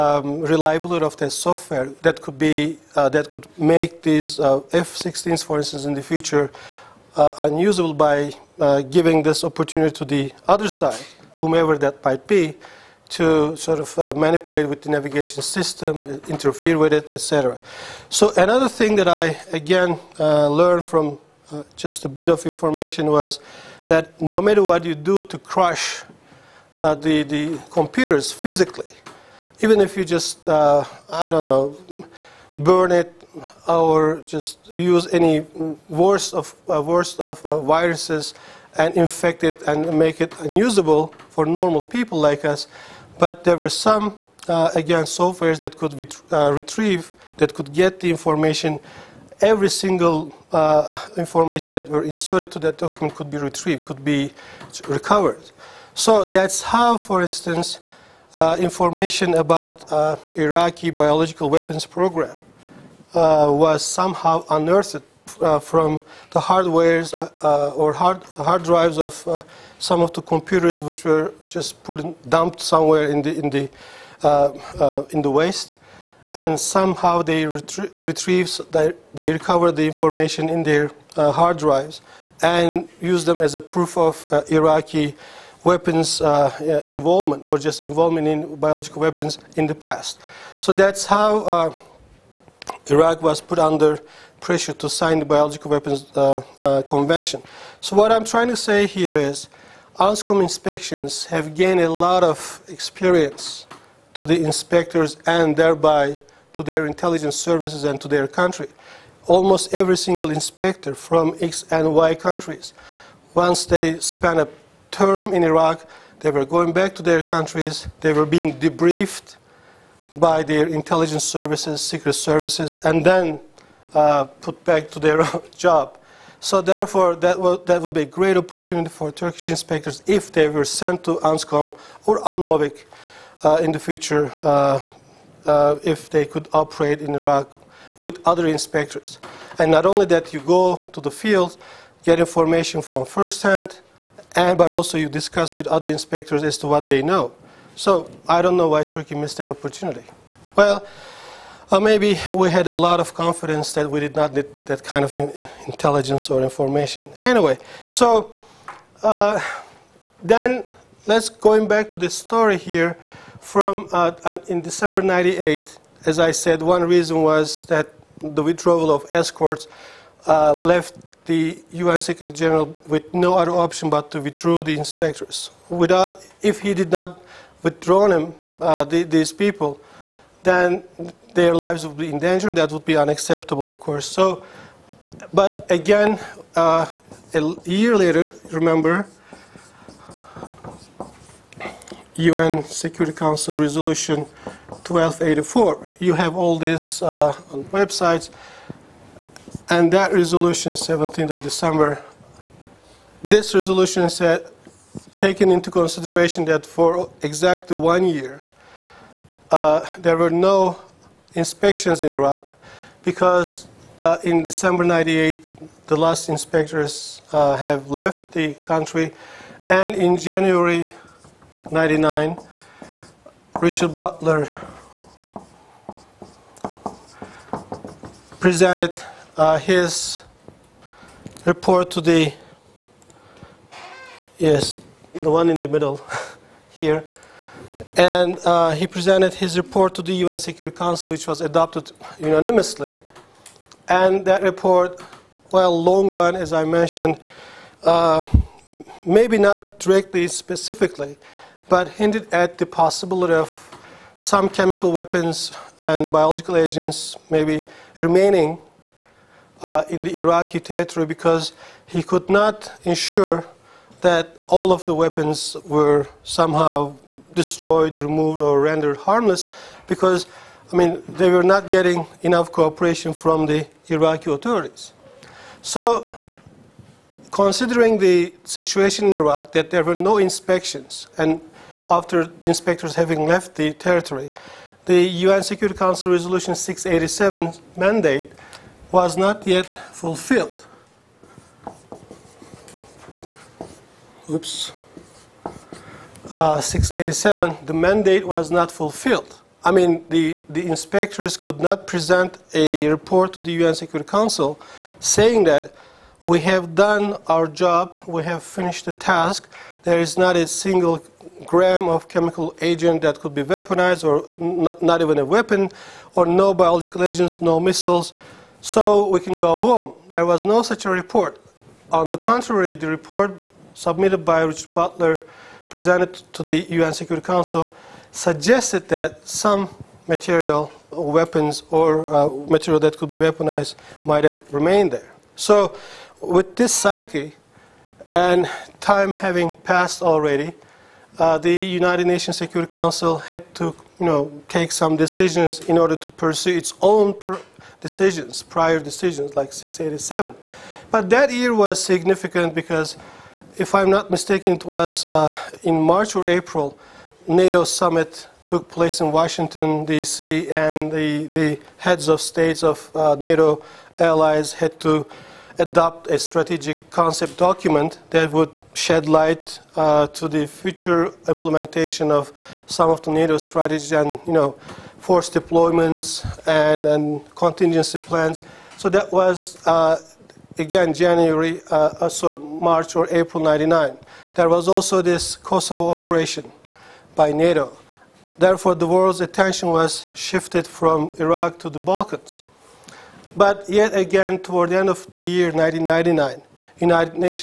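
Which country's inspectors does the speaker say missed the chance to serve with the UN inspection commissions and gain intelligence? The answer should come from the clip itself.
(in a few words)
Turkey.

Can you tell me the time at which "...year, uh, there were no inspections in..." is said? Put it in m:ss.
3:28.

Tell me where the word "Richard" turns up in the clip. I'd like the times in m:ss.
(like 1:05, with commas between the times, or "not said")
3:43, 5:24.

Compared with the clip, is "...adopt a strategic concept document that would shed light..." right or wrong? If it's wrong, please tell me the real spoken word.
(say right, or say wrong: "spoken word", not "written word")
right.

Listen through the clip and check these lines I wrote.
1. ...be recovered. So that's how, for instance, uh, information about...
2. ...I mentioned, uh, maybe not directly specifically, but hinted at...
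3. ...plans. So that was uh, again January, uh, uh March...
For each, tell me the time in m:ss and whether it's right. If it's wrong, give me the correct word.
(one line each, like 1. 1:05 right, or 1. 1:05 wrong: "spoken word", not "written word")
1. 0:54 right
2. 4:06 right
3. 6:17 right.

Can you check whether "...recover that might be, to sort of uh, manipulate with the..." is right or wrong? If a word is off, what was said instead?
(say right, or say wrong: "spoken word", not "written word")
wrong: "whomever", not "recover".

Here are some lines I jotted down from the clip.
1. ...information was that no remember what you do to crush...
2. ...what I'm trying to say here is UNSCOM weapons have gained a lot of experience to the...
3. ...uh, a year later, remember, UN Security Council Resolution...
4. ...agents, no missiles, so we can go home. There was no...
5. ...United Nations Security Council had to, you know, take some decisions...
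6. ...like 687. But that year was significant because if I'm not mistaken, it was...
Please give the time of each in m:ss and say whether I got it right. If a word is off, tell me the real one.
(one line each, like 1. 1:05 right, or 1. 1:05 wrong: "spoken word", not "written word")
1. 0:22 wrong: "matter", not "remember"
2. 1:37 wrong: "inspections", not "weapons"
3. 3:06 right
4. 5:17 right
5. 5:41 right
6. 5:49 right.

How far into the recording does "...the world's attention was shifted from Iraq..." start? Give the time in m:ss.
6:28.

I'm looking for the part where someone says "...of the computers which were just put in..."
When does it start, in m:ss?
1:10.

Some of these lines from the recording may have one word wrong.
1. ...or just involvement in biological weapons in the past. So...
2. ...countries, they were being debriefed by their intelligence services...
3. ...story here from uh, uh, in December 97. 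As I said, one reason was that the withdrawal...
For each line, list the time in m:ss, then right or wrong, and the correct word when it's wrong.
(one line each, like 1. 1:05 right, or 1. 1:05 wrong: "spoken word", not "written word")
1. 1:27 right
2. 1:57 right
3. 2:42 wrong: "98", not "97".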